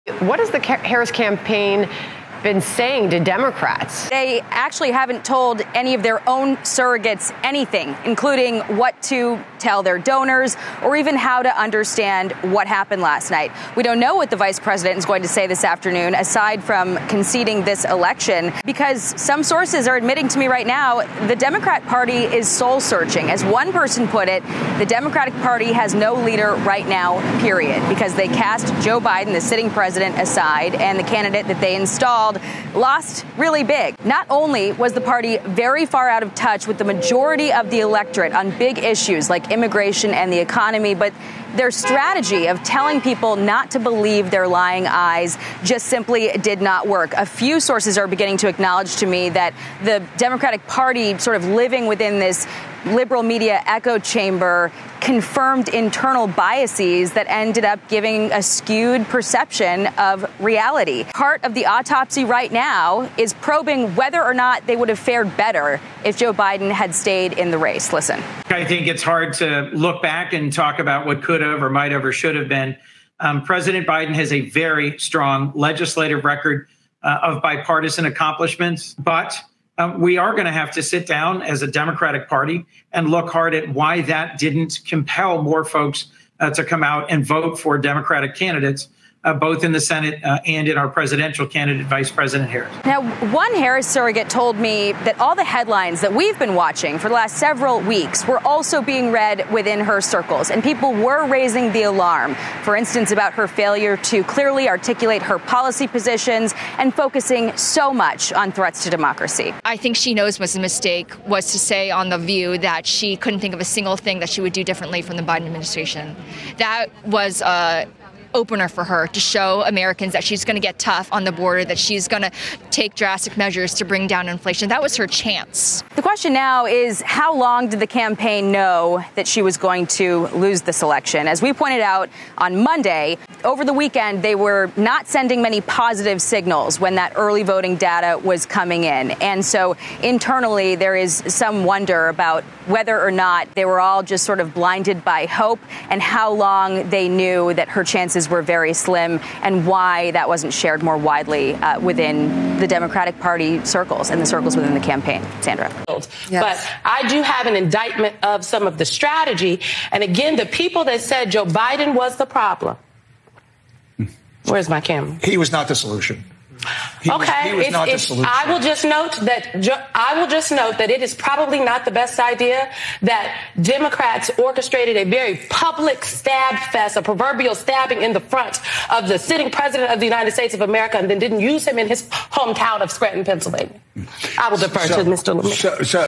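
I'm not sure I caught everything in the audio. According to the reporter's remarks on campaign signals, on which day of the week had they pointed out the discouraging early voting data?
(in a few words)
Monday.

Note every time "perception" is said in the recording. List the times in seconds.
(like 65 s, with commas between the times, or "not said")
59 s.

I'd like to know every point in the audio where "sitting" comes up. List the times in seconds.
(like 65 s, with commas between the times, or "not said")
29 s, 179 s.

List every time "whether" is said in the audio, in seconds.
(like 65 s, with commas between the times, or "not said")
63 s, 142 s.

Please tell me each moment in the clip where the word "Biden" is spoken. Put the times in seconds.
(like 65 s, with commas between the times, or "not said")
28 s, 66 s, 73 s, 115 s, 161 s.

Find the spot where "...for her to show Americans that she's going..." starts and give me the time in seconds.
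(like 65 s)
118 s.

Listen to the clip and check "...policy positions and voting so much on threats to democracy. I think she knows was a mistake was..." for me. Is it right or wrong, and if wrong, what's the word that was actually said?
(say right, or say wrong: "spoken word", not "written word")
wrong: "focusing", not "voting".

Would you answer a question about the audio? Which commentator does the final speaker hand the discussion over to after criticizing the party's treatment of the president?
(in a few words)
Mr. Lemire.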